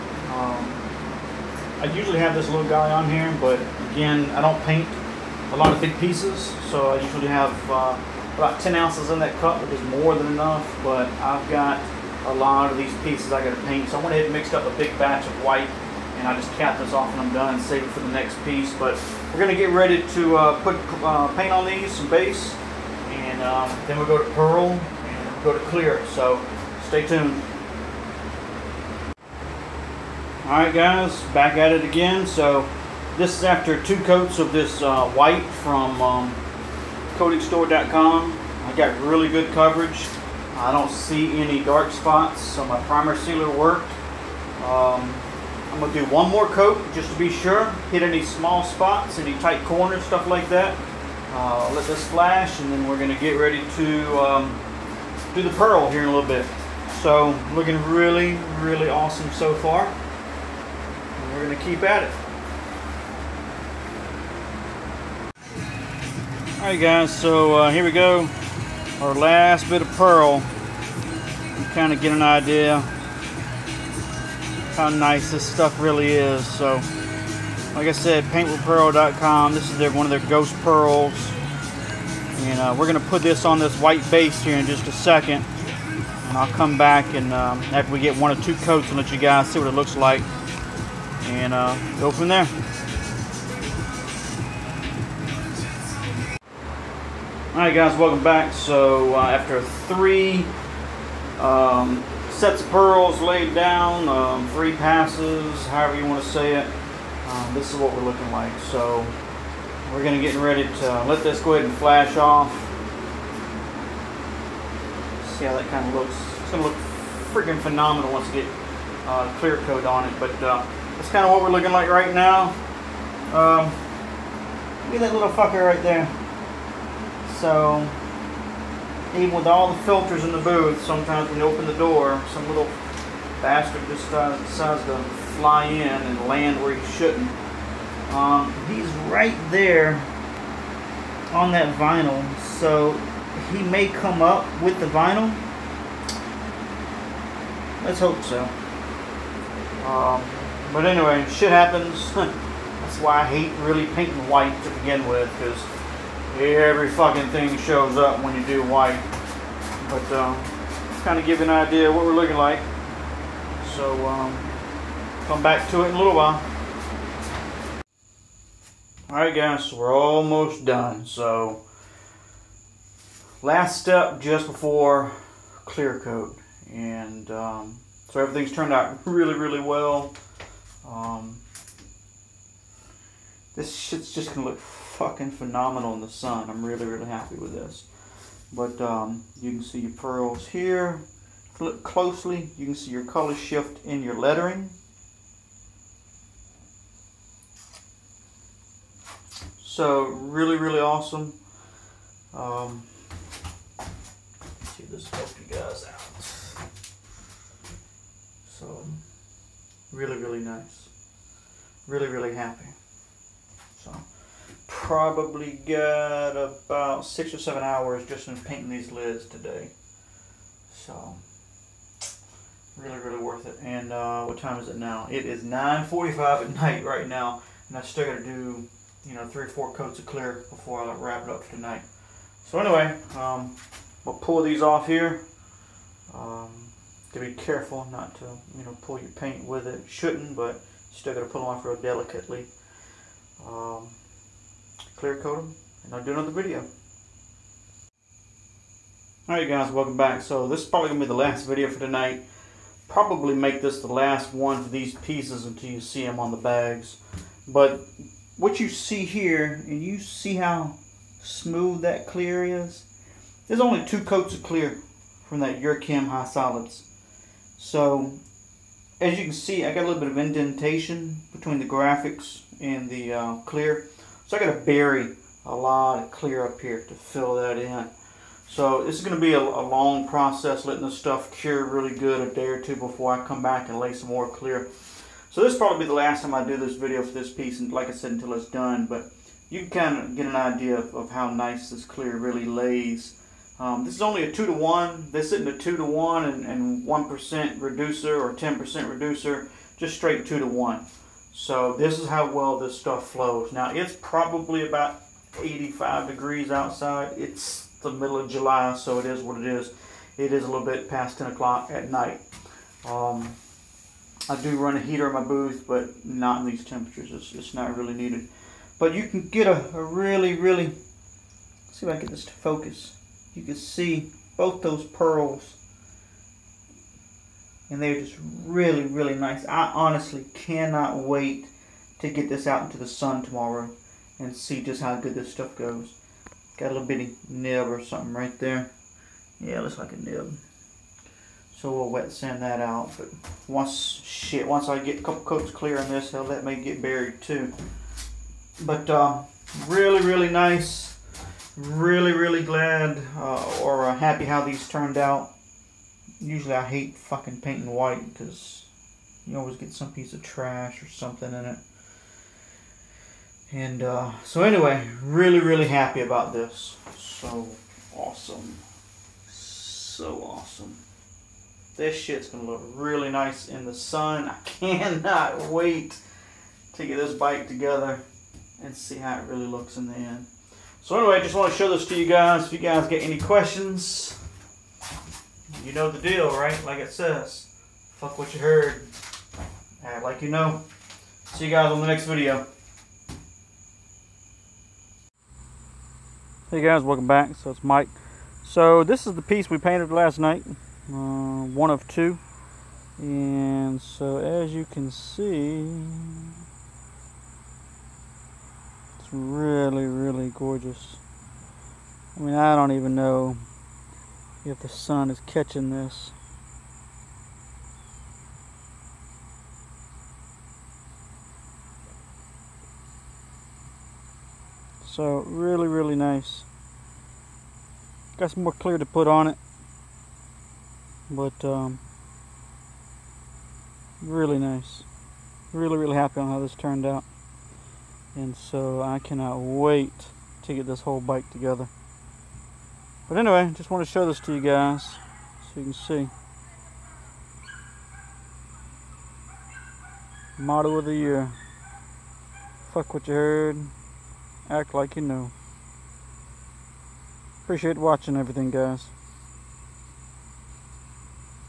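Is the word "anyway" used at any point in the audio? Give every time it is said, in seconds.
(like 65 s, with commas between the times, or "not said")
150 s, 232 s, 364 s, 380 s, 443 s.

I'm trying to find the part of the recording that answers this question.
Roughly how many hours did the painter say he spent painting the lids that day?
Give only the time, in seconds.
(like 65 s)
217 s.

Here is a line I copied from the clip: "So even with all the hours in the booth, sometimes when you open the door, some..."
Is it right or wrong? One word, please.
wrong.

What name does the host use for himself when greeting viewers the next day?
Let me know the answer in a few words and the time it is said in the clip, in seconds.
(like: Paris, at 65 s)
Mike, at 397 s.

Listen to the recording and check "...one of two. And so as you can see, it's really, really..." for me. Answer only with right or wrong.
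right.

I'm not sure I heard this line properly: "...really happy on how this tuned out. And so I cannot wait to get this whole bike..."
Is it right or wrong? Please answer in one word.
wrong.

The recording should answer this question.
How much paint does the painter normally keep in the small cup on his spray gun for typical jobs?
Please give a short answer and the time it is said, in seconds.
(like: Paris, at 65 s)
10 ounces, at 8 s.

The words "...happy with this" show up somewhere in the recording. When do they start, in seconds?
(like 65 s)
187 s.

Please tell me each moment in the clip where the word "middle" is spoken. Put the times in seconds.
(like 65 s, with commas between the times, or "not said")
307 s.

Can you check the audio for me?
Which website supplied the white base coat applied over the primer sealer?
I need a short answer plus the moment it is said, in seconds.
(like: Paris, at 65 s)
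coatingstore.com, at 37 s.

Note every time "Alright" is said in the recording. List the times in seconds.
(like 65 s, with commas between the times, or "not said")
66 s, 97 s, 169 s, 249 s.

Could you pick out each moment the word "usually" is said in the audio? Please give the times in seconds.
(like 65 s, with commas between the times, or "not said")
1 s, 7 s, 356 s.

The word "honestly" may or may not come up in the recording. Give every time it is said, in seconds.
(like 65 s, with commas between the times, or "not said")
329 s.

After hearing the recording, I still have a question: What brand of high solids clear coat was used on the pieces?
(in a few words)
Yurchem.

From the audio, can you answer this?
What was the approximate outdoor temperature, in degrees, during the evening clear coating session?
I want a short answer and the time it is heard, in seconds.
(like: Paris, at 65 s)
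85, at 305 s.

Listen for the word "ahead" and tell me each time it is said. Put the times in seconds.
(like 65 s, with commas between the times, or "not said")
14 s, 111 s.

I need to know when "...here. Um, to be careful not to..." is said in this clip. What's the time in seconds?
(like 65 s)
234 s.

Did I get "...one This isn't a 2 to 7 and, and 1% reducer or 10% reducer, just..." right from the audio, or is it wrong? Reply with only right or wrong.
wrong.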